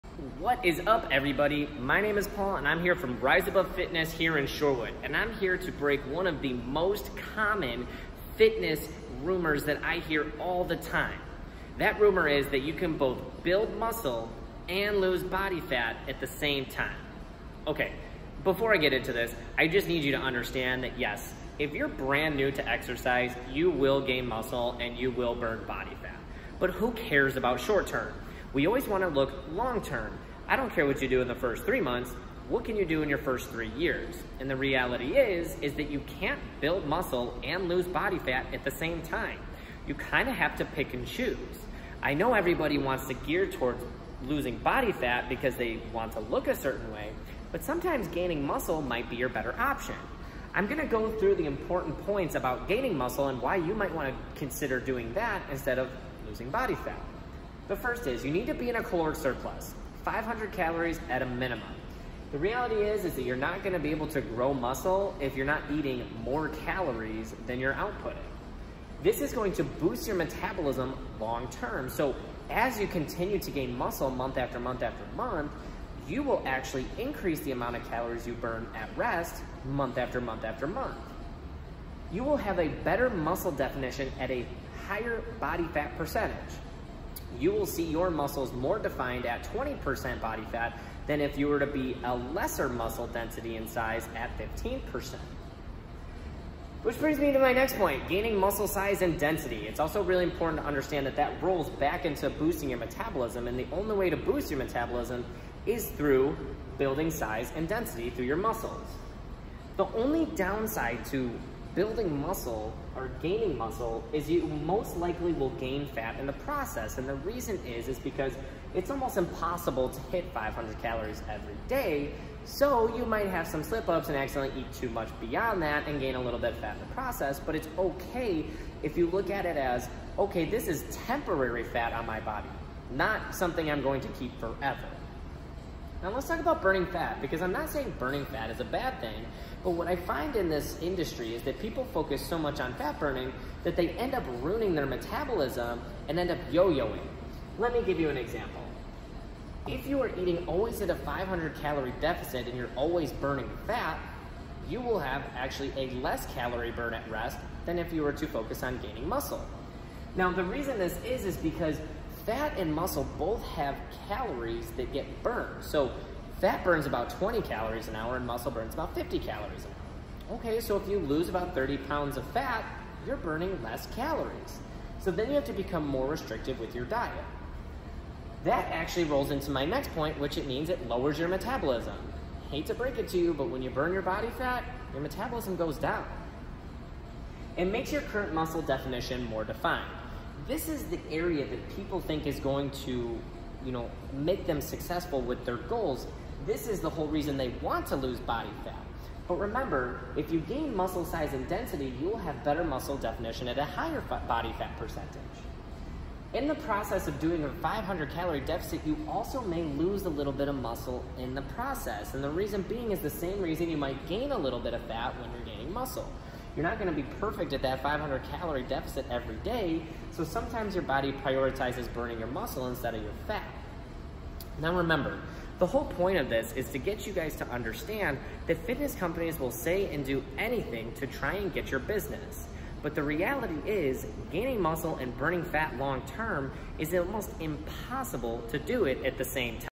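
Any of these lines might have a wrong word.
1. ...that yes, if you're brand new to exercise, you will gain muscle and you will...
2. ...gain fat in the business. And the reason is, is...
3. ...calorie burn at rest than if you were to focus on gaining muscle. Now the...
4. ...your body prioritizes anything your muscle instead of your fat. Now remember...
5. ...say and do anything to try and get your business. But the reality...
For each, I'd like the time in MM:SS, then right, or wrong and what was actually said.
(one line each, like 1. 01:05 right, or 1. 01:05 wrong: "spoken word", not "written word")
1. 00:20 right
2. 01:55 wrong: "process", not "business"
3. 02:36 right
4. 03:40 wrong: "burning", not "anything"
5. 03:49 right.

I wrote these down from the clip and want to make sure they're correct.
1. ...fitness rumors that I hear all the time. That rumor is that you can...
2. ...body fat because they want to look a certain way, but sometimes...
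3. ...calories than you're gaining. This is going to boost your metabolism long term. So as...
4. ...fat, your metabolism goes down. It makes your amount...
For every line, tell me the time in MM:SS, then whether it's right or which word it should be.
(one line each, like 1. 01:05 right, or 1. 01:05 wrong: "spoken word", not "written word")
1. 00:08 right
2. 00:44 right
3. 01:06 wrong: "outputting", not "gaining"
4. 03:04 wrong: "current", not "amount".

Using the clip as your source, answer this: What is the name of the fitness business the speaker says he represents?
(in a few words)
Rise Above Fitness.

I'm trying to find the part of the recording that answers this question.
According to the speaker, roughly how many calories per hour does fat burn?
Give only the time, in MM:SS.
02:47.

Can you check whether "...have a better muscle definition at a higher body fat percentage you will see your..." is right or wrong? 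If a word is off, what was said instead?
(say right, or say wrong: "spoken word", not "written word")
right.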